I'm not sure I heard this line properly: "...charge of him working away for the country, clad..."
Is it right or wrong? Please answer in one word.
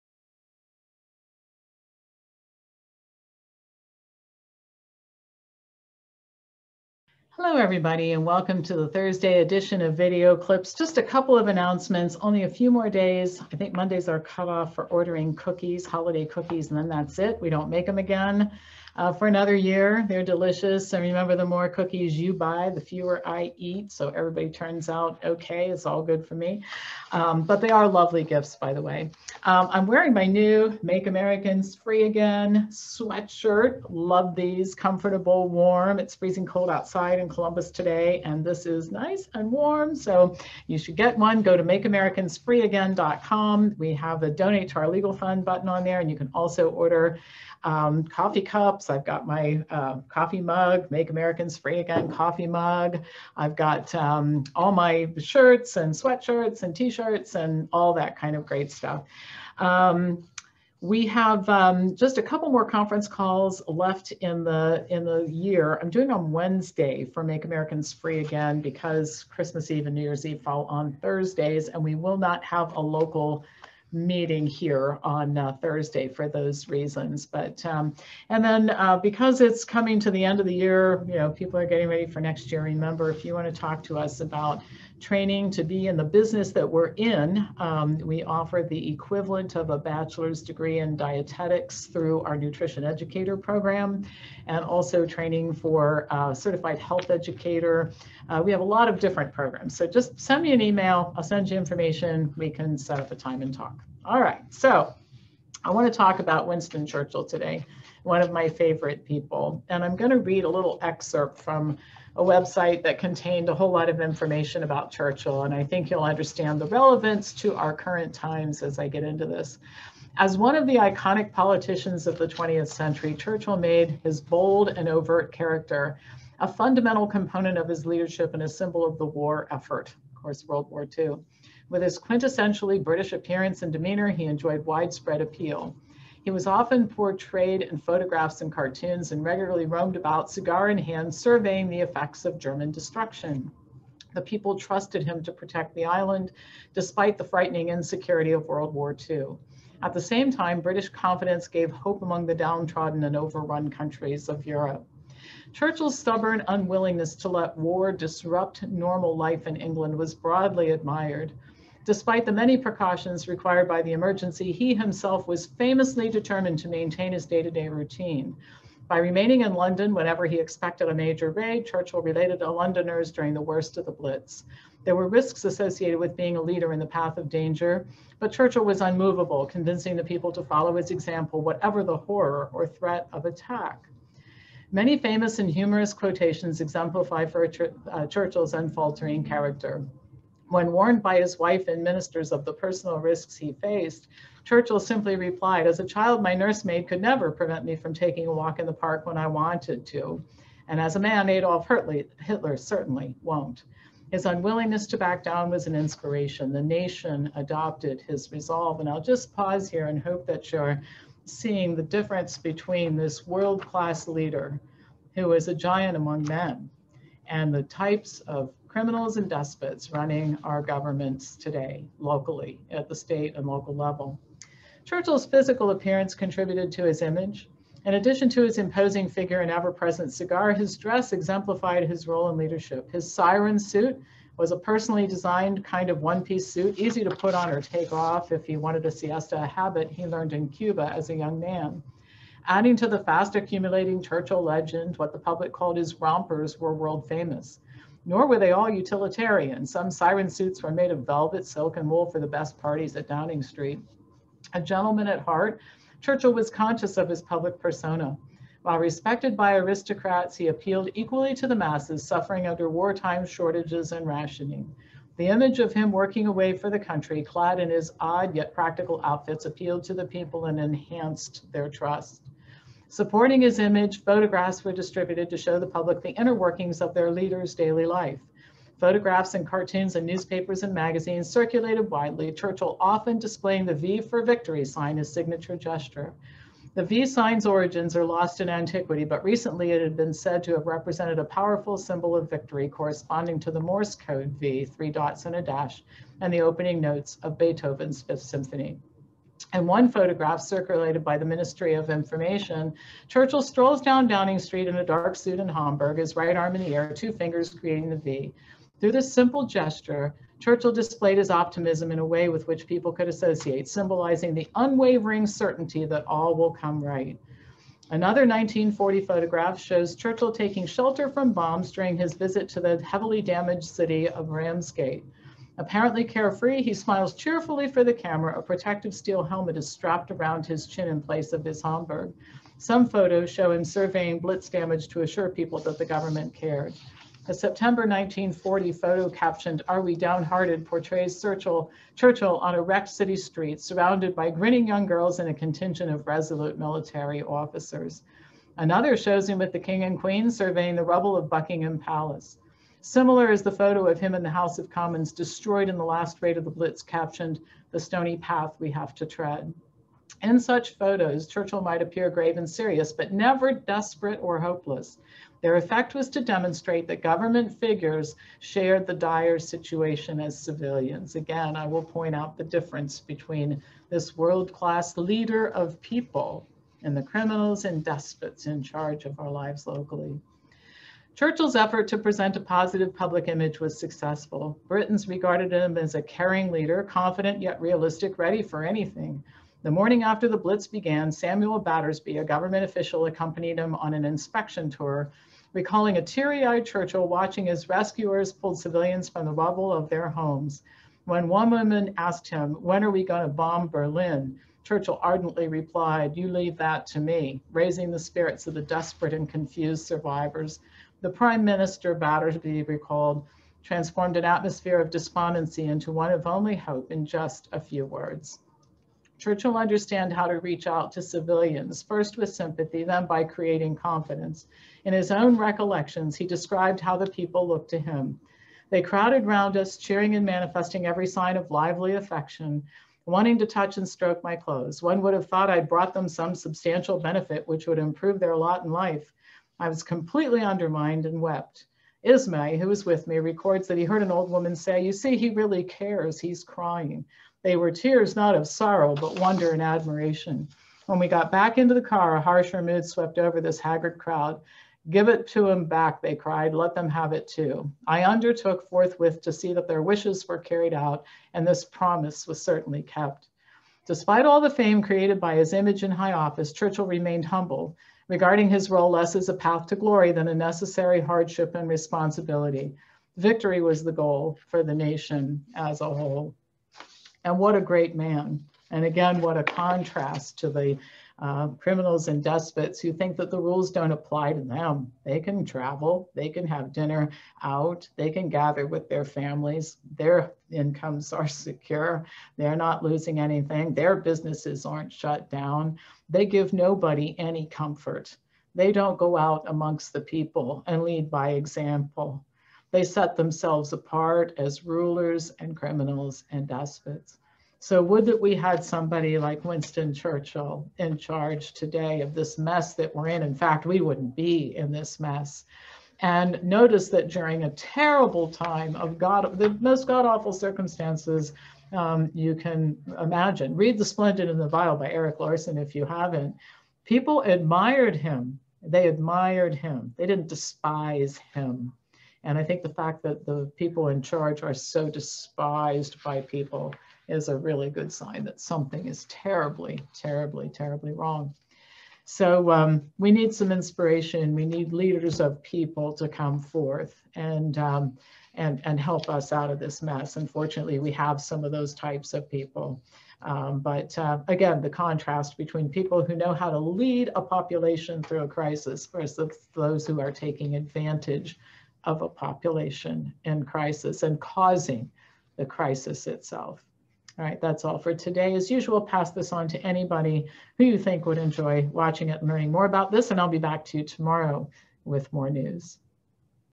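wrong.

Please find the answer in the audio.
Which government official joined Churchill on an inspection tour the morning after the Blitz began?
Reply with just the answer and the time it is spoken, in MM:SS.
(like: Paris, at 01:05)
Samuel Battersby, at 06:31.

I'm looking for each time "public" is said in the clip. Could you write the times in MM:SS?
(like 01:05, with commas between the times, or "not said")
04:05, 04:17, 04:35, 06:22.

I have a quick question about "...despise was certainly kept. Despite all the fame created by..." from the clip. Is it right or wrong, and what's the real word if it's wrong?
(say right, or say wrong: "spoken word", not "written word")
wrong: "promise", not "despise".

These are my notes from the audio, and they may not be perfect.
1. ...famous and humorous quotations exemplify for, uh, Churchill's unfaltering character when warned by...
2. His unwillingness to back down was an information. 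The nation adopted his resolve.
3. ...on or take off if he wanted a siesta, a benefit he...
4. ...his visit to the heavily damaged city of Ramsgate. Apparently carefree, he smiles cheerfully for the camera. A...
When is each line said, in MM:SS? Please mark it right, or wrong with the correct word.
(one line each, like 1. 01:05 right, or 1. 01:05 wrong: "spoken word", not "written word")
1. 03:04 right
2. 03:24 wrong: "inspiration", not "information"
3. 03:57 wrong: "habit", not "benefit"
4. 05:21 right.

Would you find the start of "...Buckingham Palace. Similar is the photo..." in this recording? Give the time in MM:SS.
05:51.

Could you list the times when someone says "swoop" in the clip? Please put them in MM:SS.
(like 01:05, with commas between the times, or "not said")
not said.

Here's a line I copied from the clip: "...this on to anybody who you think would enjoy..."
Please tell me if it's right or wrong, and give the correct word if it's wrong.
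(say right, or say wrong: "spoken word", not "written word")
right.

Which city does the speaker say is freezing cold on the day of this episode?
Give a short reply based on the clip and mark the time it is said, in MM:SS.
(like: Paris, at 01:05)
Columbus, at 00:37.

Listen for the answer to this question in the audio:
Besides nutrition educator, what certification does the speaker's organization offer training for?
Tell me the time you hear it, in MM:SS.
01:36.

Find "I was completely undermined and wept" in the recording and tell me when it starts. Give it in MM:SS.
07:19.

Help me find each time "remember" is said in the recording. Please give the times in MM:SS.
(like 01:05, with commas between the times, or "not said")
00:21, 01:22.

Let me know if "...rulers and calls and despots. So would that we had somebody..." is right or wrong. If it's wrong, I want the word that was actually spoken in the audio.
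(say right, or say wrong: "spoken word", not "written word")
wrong: "criminals", not "calls".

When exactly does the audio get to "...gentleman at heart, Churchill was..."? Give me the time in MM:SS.
04:14.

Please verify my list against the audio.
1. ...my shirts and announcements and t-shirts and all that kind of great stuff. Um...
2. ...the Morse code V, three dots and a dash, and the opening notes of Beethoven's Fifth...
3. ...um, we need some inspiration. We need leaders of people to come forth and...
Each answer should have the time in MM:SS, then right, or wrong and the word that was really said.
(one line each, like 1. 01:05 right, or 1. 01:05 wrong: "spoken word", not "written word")
1. 00:54 wrong: "sweatshirts", not "announcements"
2. 04:53 right
3. 09:02 right.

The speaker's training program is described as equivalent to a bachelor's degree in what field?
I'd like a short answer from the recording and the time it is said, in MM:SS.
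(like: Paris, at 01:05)
dietetics, at 01:30.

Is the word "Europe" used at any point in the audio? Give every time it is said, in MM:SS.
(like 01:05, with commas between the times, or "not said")
02:34.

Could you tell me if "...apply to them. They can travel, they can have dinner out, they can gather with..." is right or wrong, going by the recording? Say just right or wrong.
right.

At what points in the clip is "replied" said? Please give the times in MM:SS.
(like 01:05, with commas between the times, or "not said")
03:15, 06:45.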